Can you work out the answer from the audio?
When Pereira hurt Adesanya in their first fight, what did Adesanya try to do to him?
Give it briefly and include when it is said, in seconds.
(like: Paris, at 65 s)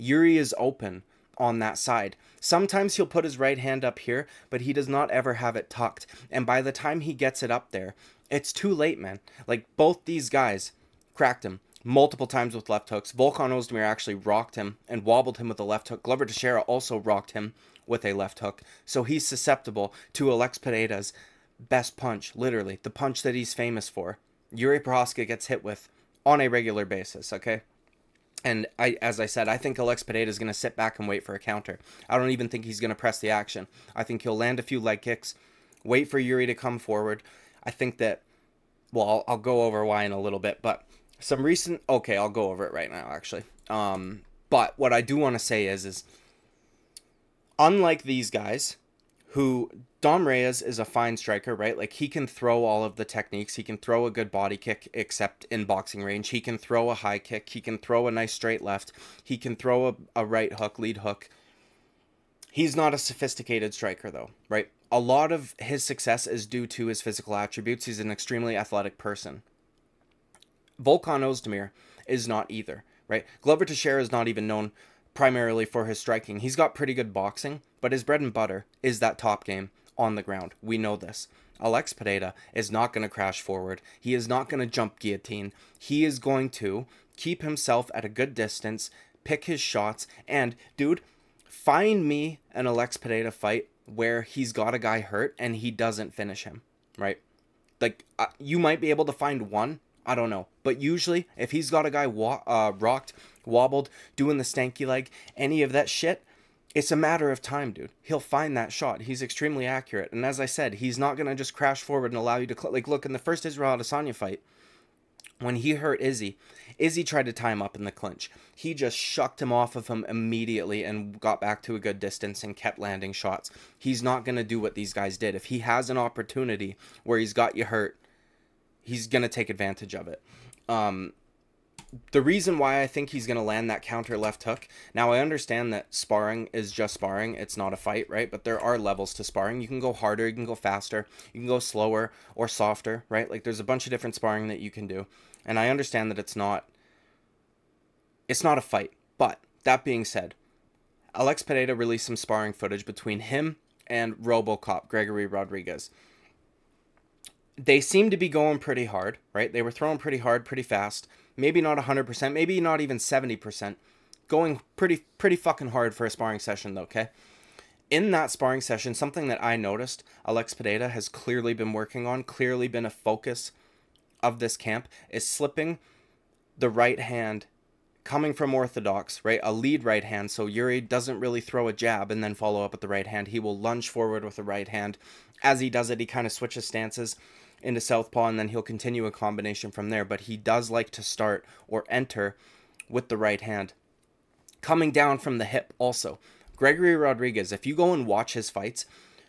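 tie him up in the clinch, at 117 s.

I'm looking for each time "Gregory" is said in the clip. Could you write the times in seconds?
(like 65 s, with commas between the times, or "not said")
154 s, 196 s.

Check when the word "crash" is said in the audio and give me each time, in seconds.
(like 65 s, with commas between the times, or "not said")
83 s, 111 s.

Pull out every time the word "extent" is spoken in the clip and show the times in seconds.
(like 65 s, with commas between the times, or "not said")
not said.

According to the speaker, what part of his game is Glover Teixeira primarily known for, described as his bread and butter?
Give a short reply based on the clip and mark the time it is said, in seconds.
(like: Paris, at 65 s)
top game on the ground, at 79 s.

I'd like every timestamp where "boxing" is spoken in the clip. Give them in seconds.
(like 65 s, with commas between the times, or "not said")
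55 s, 77 s.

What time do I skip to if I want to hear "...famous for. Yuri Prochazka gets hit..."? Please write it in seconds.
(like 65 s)
23 s.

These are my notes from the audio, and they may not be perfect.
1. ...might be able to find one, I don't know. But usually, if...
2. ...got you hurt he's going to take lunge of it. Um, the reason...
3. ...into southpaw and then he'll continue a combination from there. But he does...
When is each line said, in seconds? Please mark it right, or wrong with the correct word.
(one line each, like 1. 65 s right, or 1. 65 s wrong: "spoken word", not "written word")
1. 98 s right
2. 127 s wrong: "advantage", not "lunge"
3. 187 s right.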